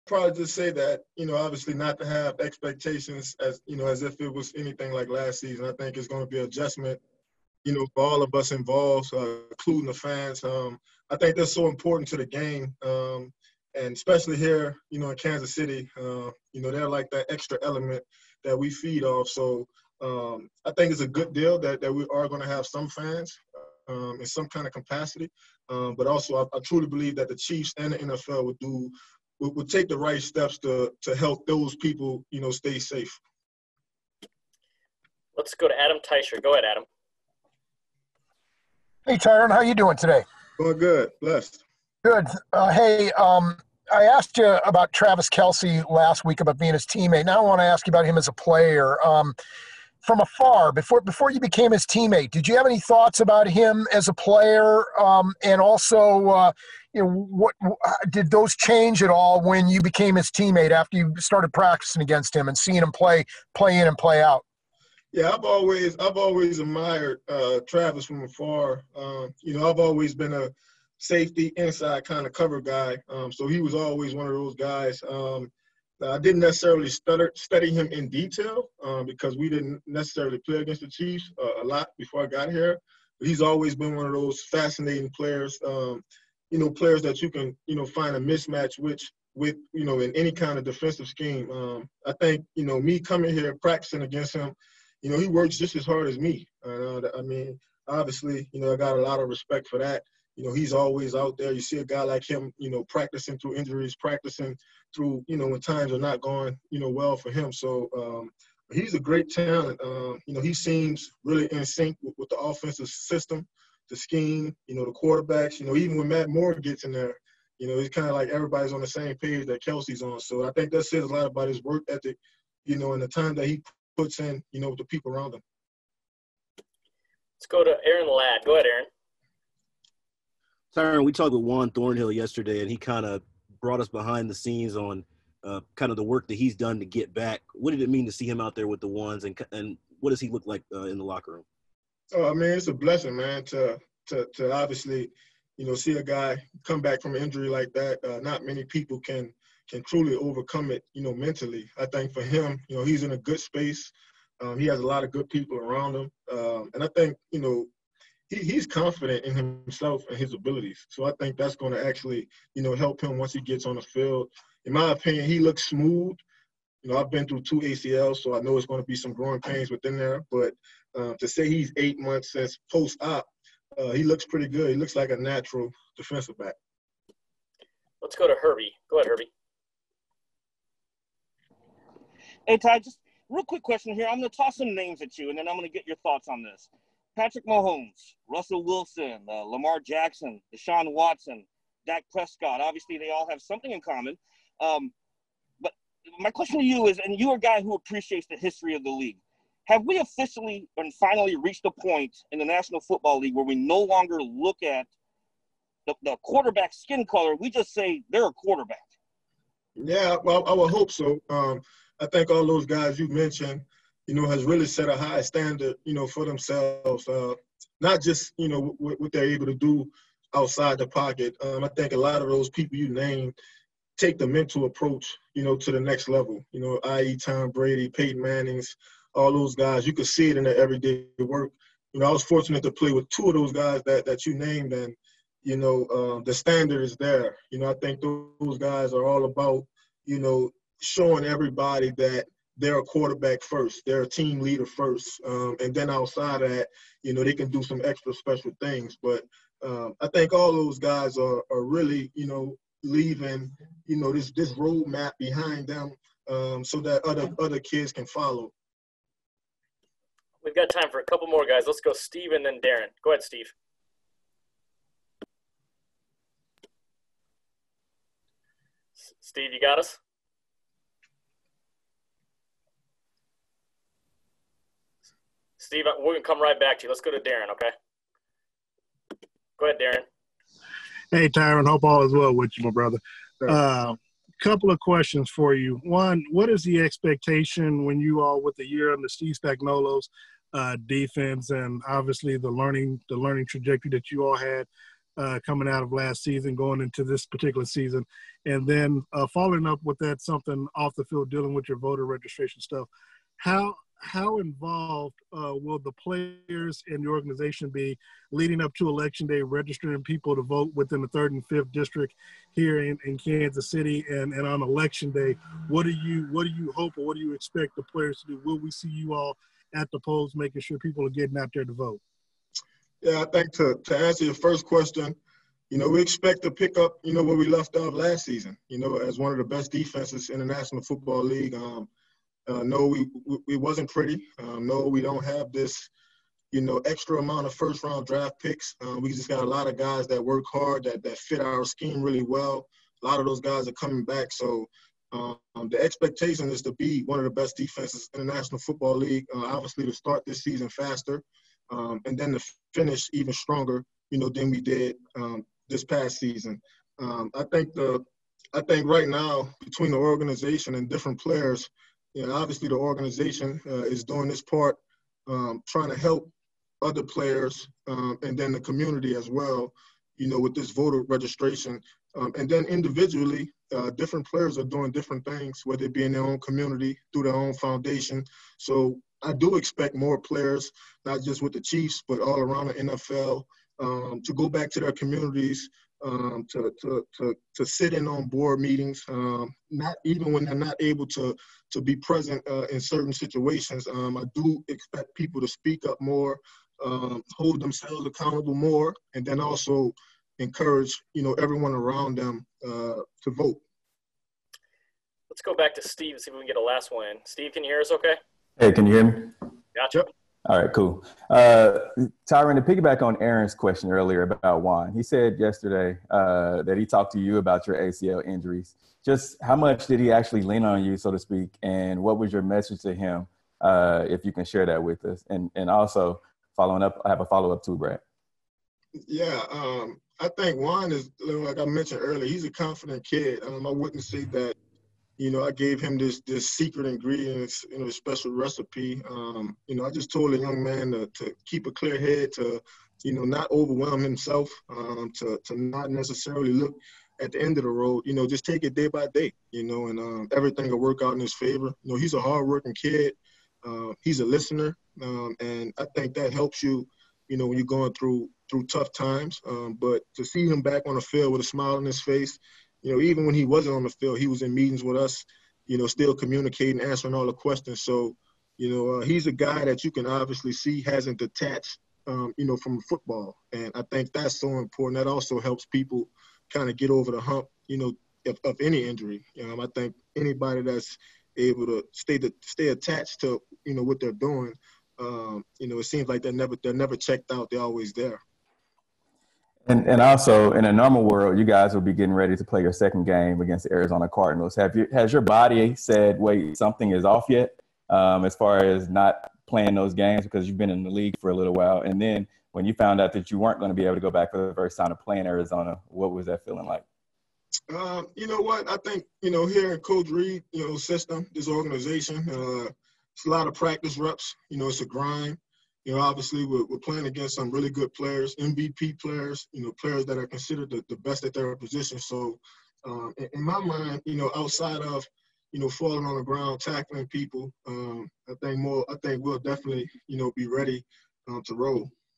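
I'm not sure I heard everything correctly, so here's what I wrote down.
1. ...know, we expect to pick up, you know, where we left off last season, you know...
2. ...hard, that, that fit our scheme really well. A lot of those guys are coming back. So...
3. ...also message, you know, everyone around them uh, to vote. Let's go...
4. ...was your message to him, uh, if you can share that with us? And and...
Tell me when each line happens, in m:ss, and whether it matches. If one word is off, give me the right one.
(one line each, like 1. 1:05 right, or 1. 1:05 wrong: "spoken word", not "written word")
1. 5:25 right
2. 5:40 right
3. 6:39 wrong: "encourage", not "message"
4. 7:02 right.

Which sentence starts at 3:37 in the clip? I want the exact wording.
Uh, not just you know what, what, they're able to do outside the pocket.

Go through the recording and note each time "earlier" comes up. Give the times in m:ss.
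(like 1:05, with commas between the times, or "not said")
6:53, 7:12.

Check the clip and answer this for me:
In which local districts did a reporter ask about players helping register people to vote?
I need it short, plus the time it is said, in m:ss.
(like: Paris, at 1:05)
Third and fifth, at 5:11.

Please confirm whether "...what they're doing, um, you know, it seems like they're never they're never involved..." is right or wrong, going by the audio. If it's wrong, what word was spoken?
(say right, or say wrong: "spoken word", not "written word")
wrong: "checked", not "involved".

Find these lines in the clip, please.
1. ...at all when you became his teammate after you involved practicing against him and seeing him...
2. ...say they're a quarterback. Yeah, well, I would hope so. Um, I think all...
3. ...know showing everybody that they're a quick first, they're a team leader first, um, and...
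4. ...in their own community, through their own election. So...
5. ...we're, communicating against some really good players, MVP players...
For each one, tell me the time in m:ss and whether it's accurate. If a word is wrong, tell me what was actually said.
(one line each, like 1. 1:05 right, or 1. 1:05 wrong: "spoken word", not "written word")
1. 0:59 wrong: "started", not "involved"
2. 3:27 right
3. 4:00 wrong: "quarterback", not "quick"
4. 6:16 wrong: "foundation", not "election"
5. 8:36 wrong: "playing", not "communicating".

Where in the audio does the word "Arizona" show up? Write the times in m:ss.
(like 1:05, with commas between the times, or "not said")
8:13, 8:25.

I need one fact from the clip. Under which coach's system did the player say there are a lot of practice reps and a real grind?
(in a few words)
Coach Reid.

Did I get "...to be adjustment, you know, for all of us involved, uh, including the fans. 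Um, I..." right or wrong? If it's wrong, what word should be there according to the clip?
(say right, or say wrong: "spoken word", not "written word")
right.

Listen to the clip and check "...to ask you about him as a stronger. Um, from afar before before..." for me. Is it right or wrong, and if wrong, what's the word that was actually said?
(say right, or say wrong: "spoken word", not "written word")
wrong: "player", not "stronger".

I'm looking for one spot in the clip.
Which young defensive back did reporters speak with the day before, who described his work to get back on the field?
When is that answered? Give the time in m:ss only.
2:11.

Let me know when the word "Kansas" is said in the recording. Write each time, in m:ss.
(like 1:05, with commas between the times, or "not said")
0:15, 5:13.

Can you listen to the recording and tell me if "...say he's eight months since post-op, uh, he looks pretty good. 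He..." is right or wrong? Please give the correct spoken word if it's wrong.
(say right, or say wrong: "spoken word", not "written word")
right.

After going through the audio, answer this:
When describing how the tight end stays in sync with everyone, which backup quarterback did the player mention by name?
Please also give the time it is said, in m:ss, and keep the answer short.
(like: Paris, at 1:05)
Matt Moore, at 1:56.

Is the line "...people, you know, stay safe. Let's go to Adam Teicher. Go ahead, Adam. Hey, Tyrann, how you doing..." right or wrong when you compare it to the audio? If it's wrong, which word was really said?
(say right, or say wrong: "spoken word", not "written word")
right.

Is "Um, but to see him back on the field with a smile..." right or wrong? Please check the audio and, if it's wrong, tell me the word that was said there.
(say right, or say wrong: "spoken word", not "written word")
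right.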